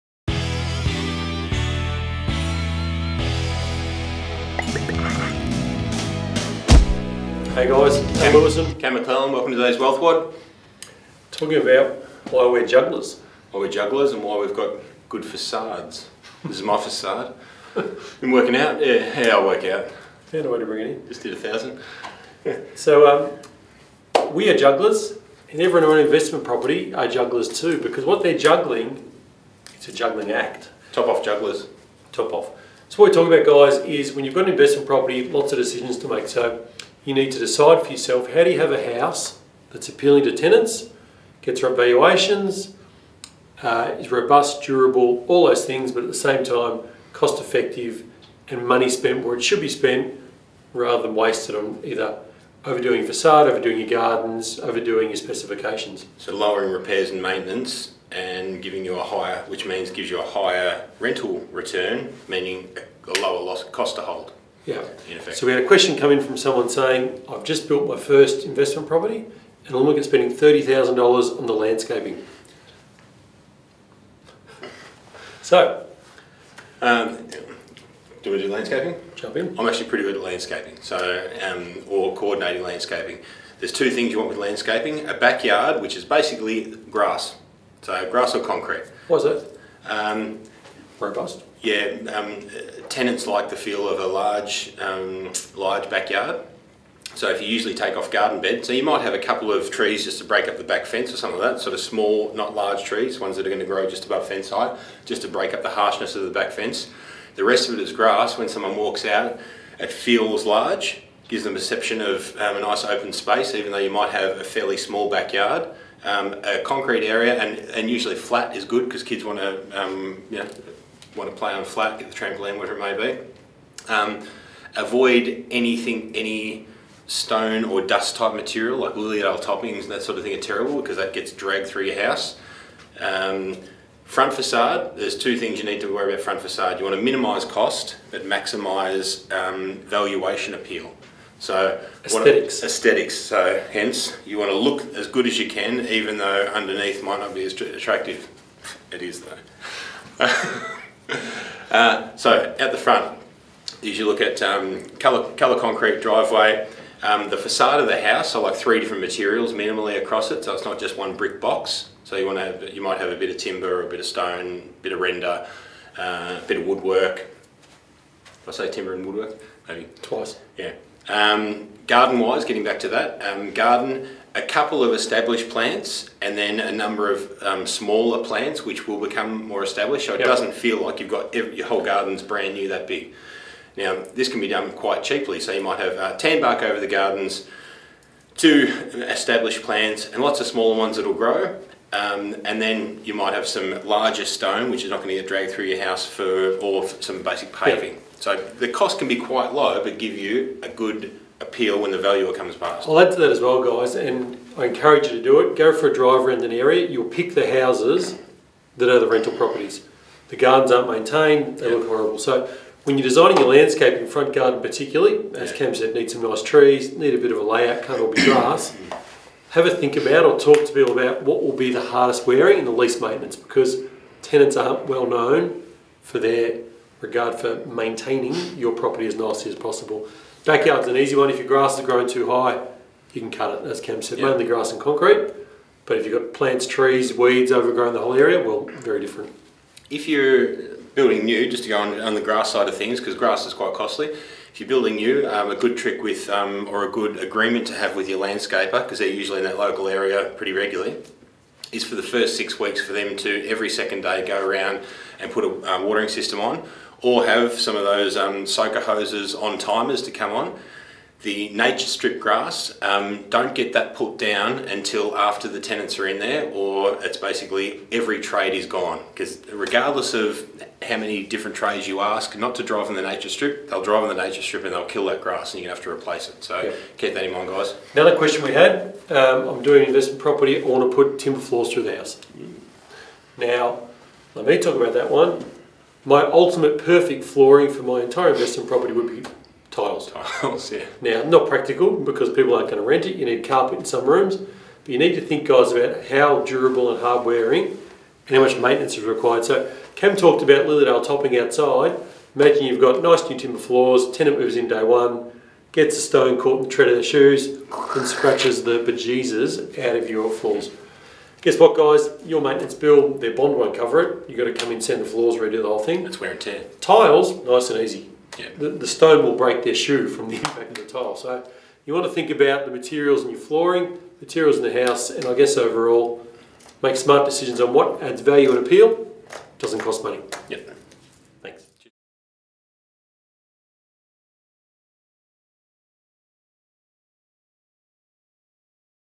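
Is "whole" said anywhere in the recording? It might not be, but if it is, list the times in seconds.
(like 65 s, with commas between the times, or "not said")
181 s, 237 s, 315 s.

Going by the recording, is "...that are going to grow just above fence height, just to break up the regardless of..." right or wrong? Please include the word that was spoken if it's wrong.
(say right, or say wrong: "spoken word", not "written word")
wrong: "harshness", not "regardless".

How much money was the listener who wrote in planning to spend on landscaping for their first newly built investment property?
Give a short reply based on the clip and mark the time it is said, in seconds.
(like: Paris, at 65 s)
$30,000, at 70 s.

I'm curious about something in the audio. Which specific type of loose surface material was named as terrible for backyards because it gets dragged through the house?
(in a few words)
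Lilydale toppings.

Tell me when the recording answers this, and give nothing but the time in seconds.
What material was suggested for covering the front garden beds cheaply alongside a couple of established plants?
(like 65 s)
186 s.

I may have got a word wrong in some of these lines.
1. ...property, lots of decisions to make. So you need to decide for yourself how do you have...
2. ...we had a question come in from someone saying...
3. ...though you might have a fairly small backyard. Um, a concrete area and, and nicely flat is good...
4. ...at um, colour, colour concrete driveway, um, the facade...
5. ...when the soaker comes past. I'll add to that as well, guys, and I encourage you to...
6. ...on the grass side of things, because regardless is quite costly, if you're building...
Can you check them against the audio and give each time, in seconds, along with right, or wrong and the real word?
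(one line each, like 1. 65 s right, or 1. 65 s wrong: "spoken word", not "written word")
1. 34 s right
2. 65 s right
3. 113 s wrong: "usually", not "nicely"
4. 154 s right
5. 201 s wrong: "valuer", not "soaker"
6. 241 s wrong: "grass", not "regardless".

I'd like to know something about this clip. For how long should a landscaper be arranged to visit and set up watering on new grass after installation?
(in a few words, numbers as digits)
Six weeks.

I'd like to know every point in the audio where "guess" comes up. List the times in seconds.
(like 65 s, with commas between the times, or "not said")
311 s, 325 s.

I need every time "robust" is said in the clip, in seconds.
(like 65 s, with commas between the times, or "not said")
44 s, 90 s.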